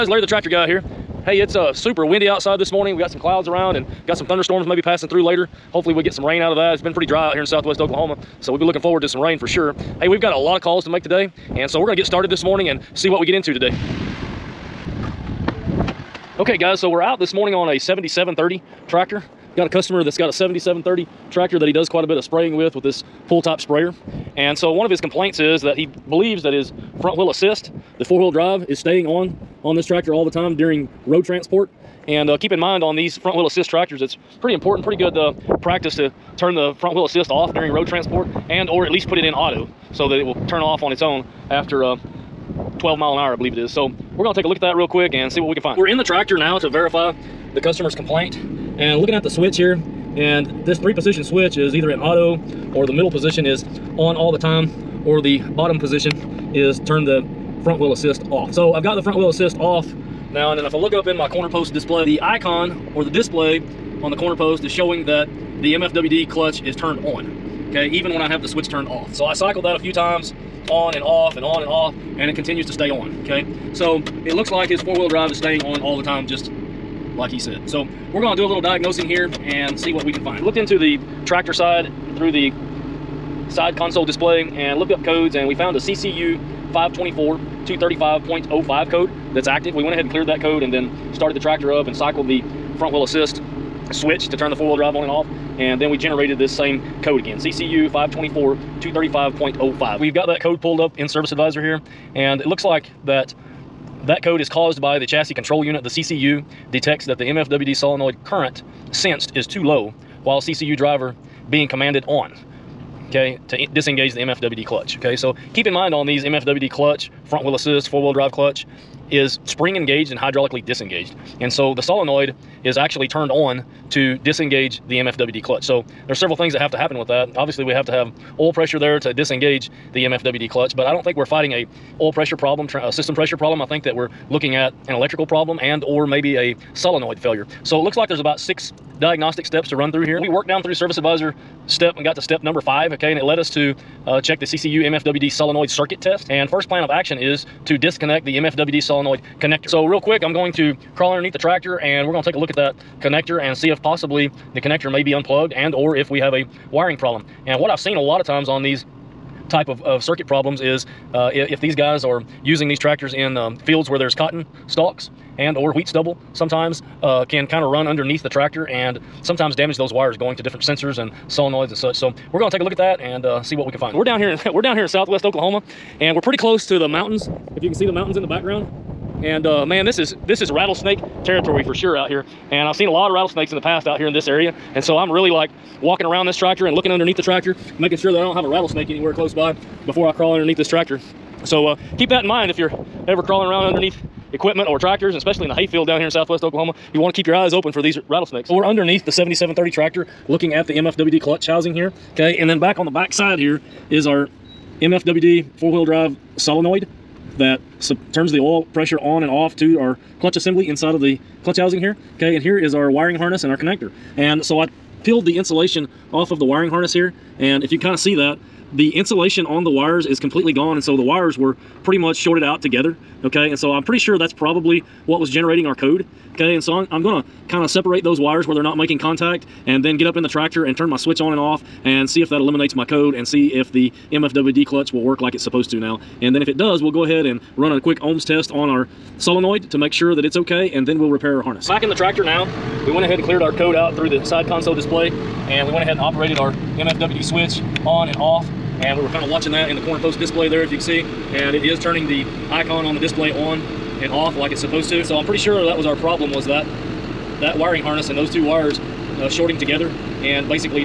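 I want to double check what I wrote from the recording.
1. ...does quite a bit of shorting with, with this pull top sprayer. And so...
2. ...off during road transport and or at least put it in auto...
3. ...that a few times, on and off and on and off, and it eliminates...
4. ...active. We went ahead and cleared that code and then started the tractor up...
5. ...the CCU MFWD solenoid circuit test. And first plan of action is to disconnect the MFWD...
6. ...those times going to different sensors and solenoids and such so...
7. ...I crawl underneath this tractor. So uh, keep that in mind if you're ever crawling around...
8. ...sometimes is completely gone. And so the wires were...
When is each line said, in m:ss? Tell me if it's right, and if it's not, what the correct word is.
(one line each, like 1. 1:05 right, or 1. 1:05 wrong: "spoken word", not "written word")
1. 0:21 wrong: "spraying", not "shorting"
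2. 0:37 right
3. 1:09 wrong: "continues", not "eliminates"
4. 1:29 right
5. 2:24 right
6. 2:49 wrong: "wires", not "times"
7. 3:10 right
8. 3:39 wrong: "wires", not "sometimes".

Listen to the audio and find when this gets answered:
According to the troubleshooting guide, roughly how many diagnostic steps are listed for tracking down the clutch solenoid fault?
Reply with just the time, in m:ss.
2:18.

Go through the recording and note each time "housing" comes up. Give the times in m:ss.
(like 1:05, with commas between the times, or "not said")
3:21, 3:31.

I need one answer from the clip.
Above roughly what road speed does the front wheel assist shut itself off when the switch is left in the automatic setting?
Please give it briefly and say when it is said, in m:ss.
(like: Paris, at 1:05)
12 mph, at 0:42.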